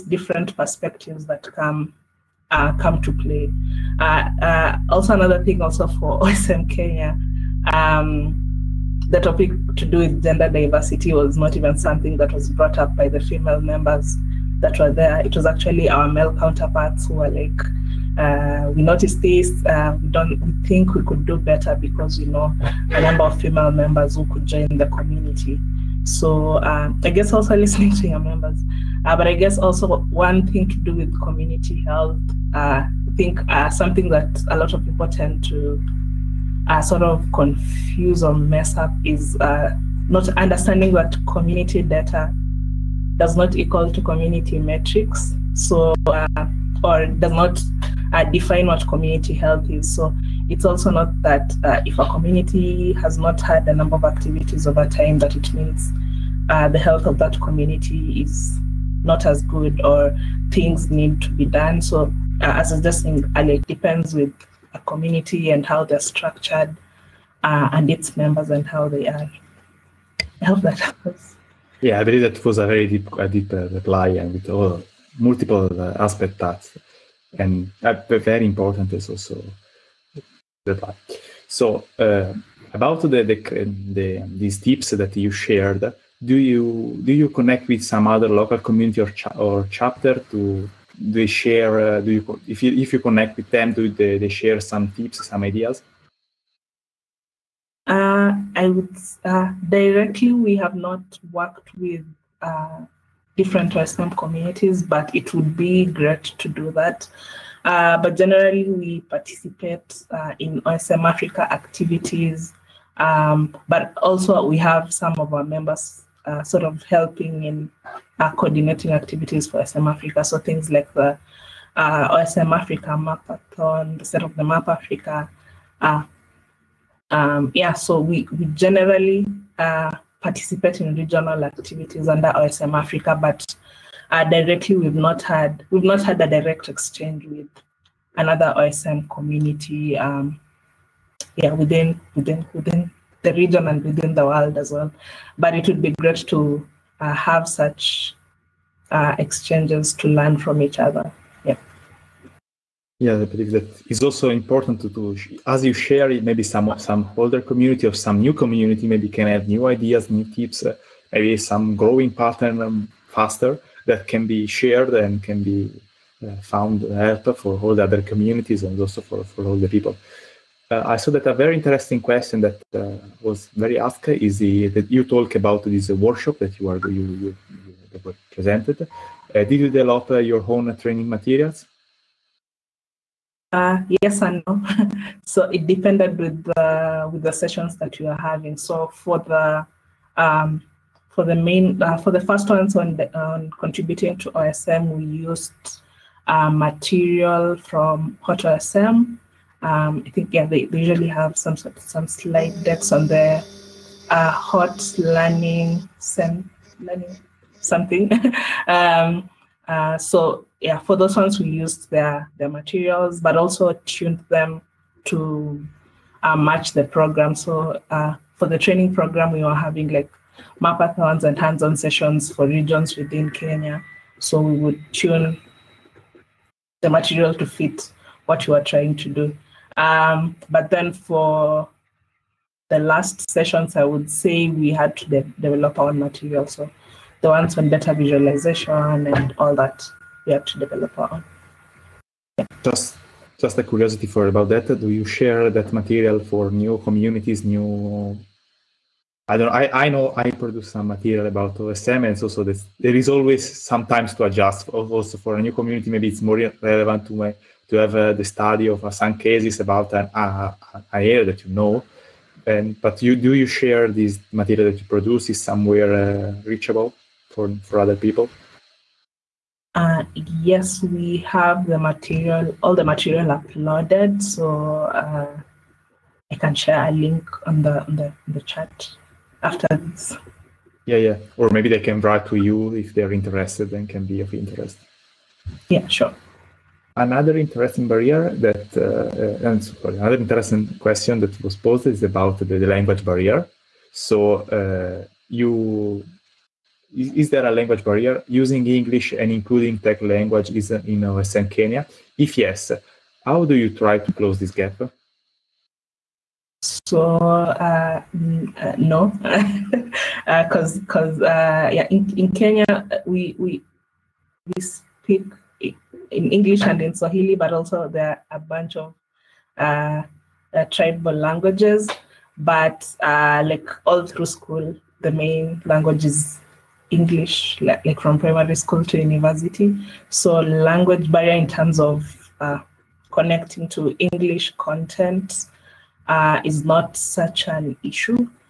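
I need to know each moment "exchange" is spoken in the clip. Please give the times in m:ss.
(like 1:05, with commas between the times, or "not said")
2:16, 2:29.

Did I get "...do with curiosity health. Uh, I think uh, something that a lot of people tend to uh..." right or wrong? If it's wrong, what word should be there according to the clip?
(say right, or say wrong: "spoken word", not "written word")
wrong: "community", not "curiosity".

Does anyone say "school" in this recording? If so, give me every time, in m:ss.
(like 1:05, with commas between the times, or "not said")
5:24, 5:28.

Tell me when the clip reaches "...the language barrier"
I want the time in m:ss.
4:52.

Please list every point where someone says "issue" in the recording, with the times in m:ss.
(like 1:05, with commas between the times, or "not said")
5:37.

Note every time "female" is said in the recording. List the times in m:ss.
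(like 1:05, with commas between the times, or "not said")
0:13, 0:23.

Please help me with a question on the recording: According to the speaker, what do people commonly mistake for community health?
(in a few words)
community data.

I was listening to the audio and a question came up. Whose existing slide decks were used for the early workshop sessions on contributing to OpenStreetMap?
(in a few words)
HOTOSM.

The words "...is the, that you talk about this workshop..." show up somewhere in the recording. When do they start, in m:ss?
2:54.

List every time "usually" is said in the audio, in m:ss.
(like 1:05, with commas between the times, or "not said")
3:20.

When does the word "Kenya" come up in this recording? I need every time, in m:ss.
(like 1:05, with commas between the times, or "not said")
0:06, 3:43, 5:01, 5:12.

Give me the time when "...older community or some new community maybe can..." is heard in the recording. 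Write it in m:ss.
2:37.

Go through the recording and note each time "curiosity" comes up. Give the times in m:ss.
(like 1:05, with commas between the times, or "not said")
4:03.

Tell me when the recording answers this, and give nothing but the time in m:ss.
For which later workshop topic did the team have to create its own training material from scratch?
3:57.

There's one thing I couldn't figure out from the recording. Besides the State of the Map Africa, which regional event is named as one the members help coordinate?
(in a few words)
Africa Mapathon.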